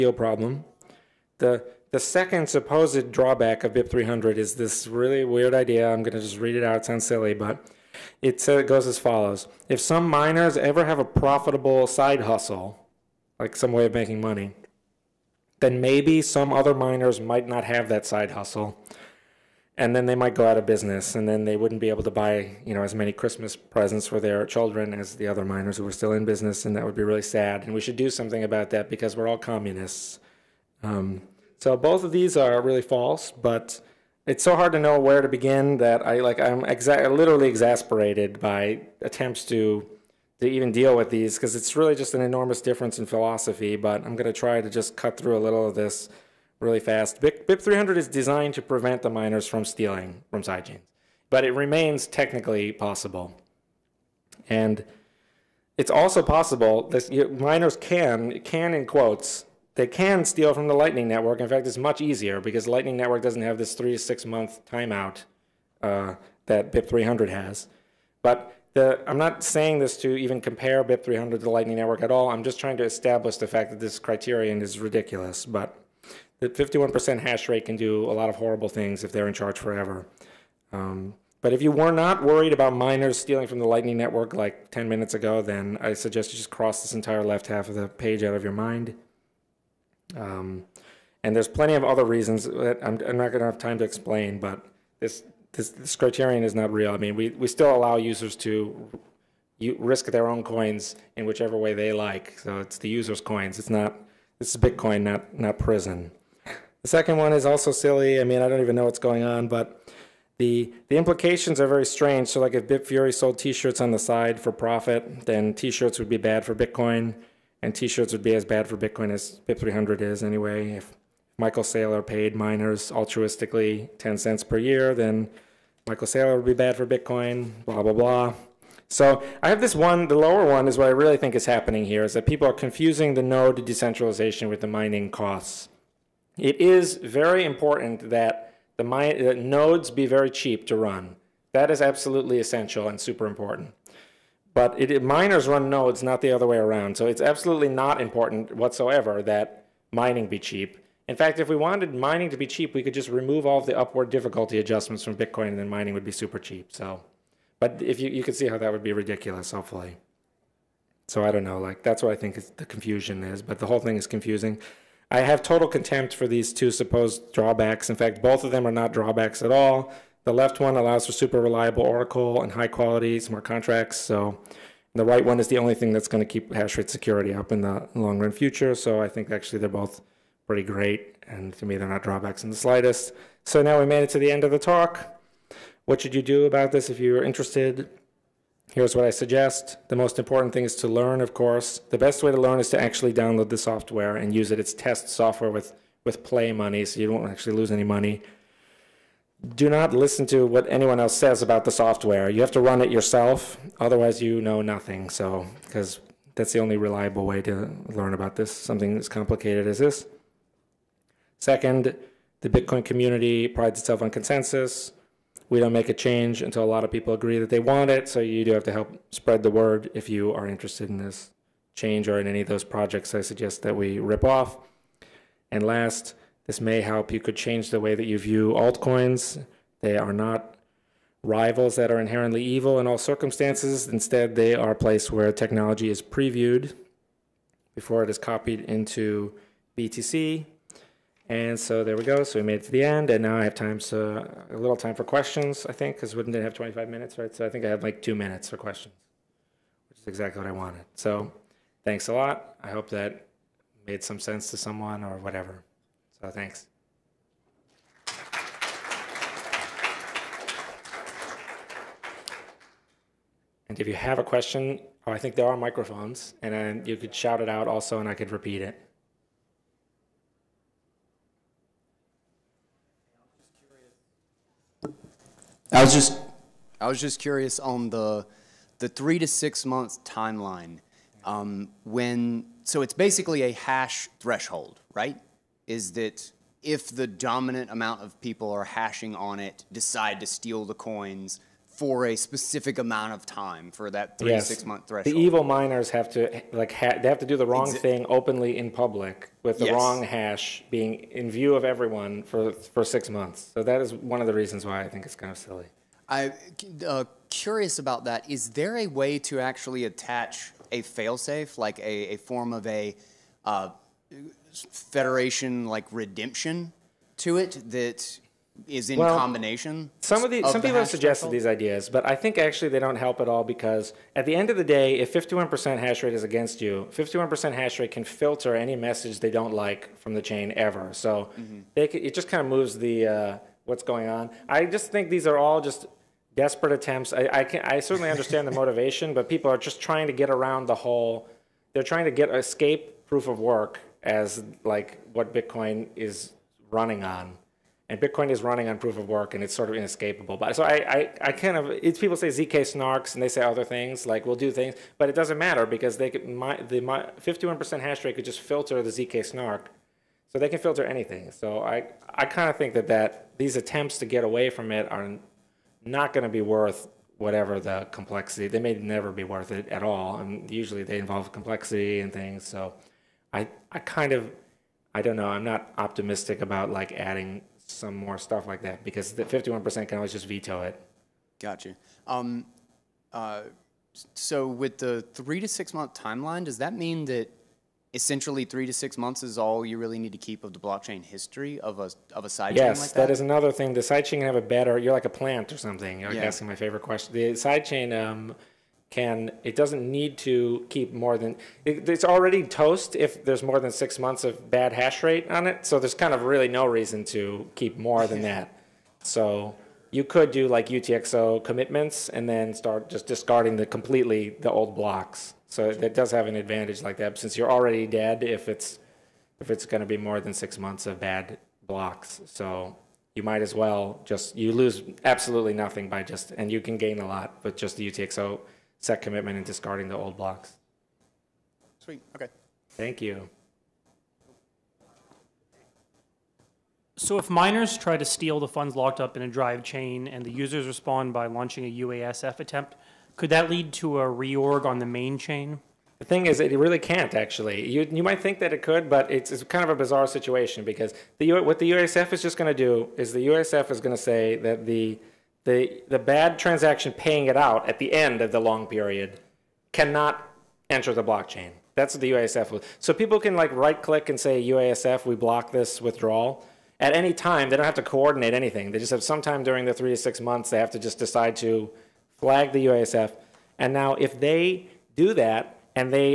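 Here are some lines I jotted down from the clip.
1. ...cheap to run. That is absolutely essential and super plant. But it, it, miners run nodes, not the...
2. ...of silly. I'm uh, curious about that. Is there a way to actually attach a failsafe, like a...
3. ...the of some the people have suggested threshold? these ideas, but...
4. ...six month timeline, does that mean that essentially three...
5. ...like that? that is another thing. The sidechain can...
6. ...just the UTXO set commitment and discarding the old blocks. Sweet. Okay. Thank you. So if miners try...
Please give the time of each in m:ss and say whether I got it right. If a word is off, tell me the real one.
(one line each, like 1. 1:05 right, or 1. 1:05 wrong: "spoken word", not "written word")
1. 2:20 wrong: "important", not "plant"
2. 5:05 right
3. 5:20 right
4. 6:25 right
5. 6:32 right
6. 7:07 right.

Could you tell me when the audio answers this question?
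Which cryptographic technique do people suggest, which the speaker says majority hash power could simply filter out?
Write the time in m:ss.
5:58.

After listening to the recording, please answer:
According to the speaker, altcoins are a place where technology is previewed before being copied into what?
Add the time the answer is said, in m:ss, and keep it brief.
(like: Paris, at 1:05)
BTC, at 3:59.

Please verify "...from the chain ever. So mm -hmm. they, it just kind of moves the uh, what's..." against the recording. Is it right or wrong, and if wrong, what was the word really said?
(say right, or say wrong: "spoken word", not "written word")
right.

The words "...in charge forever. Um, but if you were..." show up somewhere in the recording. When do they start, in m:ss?
1:19.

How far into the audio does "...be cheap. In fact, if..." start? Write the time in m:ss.
2:30.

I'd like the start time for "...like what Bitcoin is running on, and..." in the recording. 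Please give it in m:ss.
5:44.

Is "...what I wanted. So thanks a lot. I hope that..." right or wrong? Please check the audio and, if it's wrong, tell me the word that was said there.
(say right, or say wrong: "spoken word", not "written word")
right.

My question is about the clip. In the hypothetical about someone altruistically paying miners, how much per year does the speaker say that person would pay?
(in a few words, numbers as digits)
10 cents.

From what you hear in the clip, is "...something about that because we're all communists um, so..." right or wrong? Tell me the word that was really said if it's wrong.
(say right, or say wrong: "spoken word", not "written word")
right.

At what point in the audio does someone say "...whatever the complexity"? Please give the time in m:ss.
6:07.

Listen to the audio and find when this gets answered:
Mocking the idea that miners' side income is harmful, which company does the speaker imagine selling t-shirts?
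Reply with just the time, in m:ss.
1:52.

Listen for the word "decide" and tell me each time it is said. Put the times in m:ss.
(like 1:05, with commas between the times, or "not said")
4:49, 7:50.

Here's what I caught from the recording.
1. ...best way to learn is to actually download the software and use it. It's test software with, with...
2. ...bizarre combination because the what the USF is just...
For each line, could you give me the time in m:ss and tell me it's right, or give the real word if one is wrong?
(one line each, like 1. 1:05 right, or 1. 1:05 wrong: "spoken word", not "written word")
1. 3:11 right
2. 7:29 wrong: "situation", not "combination".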